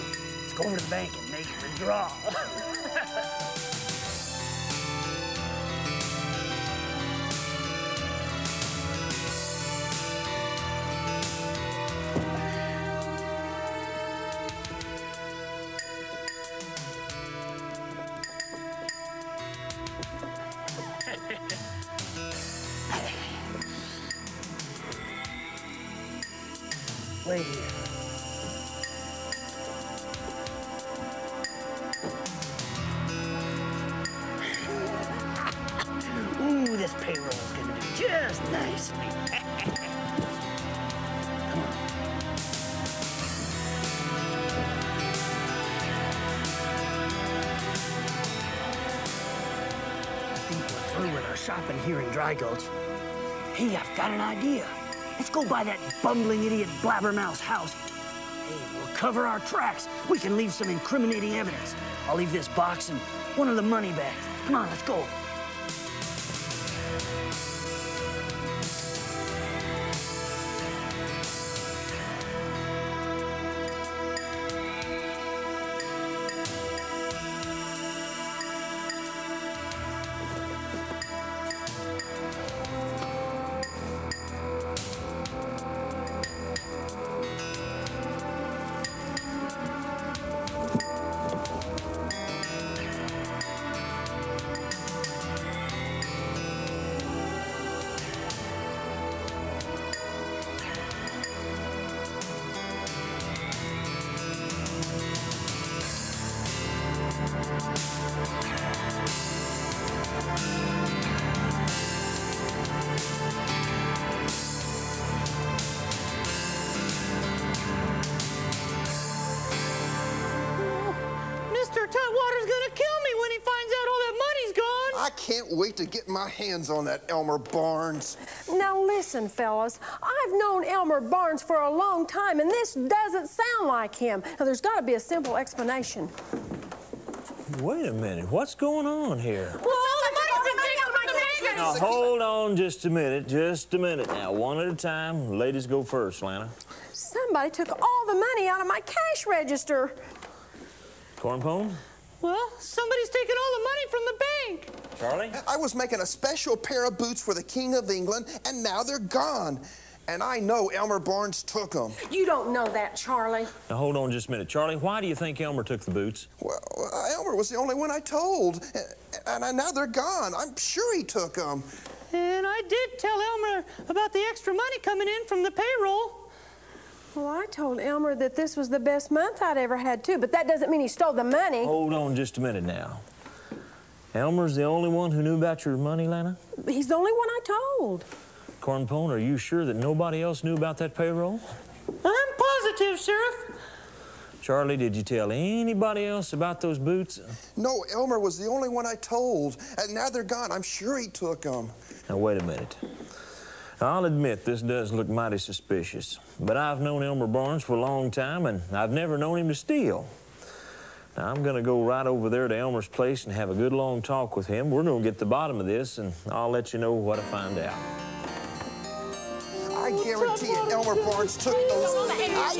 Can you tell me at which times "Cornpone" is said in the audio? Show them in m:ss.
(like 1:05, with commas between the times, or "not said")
2:31, 3:08.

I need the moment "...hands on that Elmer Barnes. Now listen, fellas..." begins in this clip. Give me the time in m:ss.
2:06.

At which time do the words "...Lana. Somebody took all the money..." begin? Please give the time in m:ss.
2:26.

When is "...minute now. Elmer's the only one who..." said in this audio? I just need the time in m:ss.
3:02.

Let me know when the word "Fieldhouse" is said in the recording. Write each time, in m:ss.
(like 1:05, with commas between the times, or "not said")
not said.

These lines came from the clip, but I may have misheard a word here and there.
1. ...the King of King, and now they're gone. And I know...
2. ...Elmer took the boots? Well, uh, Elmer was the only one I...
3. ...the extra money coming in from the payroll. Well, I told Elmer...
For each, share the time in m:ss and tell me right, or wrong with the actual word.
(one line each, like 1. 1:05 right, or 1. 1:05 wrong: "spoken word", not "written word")
1. 2:37 wrong: "England", not "King"
2. 2:45 right
3. 2:54 right.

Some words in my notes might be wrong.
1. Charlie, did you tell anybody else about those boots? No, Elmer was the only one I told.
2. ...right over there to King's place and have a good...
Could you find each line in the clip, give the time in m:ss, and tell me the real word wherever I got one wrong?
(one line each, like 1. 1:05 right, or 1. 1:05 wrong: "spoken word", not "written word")
1. 3:14 right
2. 3:31 wrong: "Elmer", not "King".